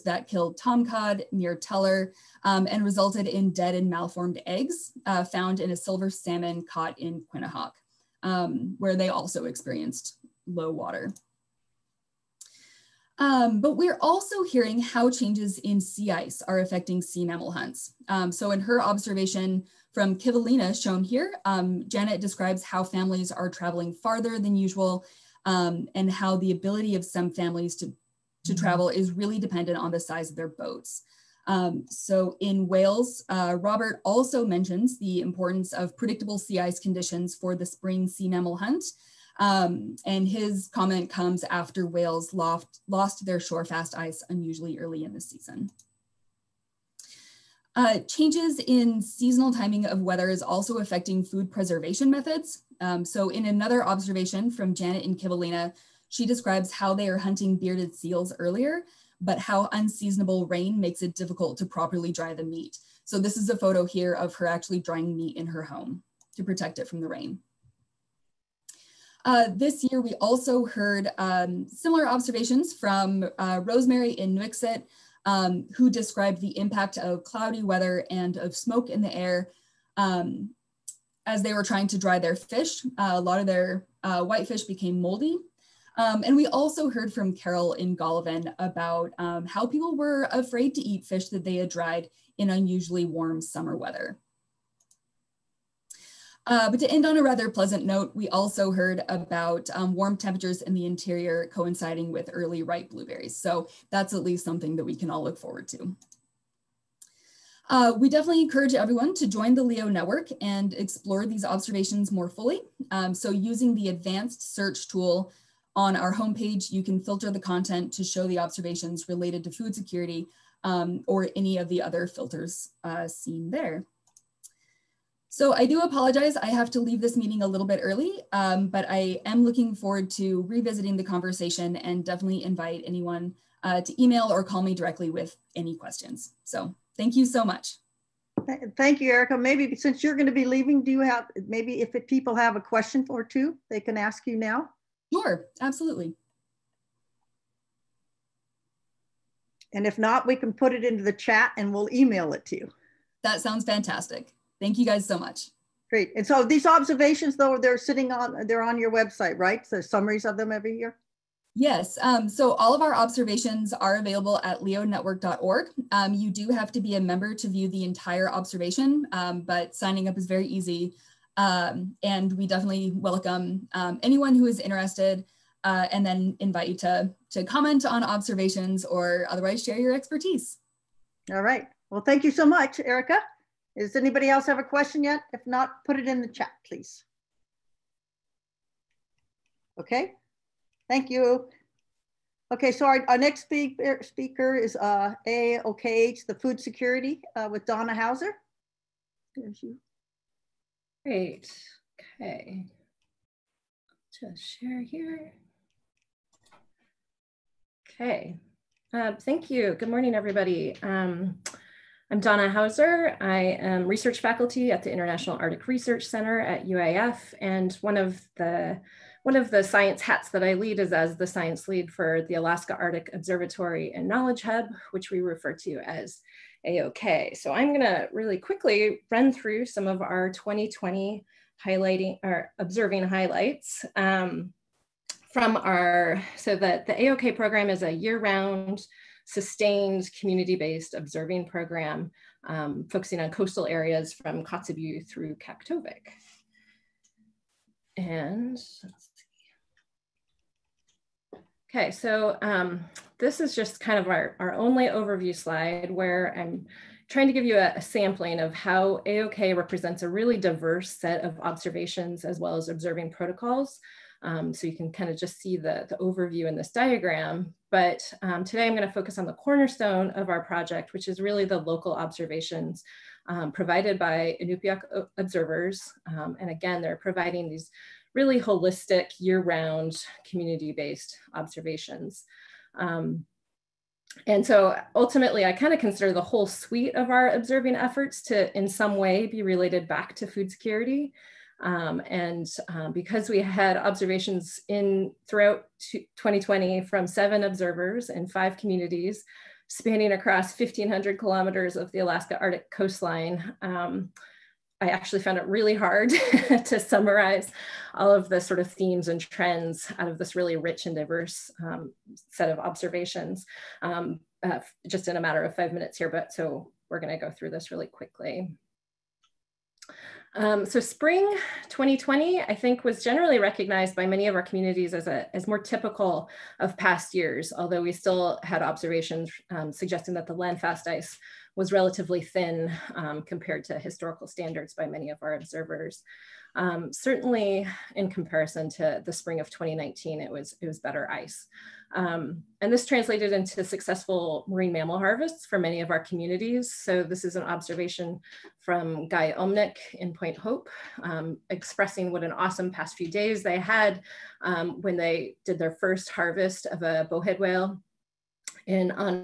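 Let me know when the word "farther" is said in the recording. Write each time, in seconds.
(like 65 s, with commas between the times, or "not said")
23 s.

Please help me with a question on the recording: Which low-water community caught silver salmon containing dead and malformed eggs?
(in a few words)
Quinhagak.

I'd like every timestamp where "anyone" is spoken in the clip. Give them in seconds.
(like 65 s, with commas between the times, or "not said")
132 s, 174 s.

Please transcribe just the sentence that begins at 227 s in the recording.
So I'm going to really quickly run through some of our 2020 highlighting or observing highlights.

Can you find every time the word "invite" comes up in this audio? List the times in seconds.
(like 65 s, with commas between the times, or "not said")
132 s, 176 s.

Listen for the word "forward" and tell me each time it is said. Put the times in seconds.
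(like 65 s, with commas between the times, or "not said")
105 s, 129 s.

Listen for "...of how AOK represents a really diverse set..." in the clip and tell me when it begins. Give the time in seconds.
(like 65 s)
258 s.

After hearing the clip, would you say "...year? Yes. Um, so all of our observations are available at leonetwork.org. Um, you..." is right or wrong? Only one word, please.
right.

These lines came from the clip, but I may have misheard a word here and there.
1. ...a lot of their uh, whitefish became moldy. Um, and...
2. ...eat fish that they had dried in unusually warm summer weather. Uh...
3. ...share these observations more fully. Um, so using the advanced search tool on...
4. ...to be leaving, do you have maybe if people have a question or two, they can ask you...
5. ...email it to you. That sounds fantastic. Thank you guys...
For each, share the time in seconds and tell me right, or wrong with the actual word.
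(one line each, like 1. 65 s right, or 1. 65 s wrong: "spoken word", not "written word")
1. 83 s right
2. 90 s right
3. 110 s wrong: "explore", not "share"
4. 140 s right
5. 151 s right.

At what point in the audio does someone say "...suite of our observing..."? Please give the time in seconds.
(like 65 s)
286 s.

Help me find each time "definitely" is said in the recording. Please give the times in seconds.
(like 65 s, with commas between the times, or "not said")
108 s, 132 s, 172 s.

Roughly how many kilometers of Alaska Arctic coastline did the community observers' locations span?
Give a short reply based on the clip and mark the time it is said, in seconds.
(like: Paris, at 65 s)
1,500, at 300 s.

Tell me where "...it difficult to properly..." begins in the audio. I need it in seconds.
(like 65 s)
61 s.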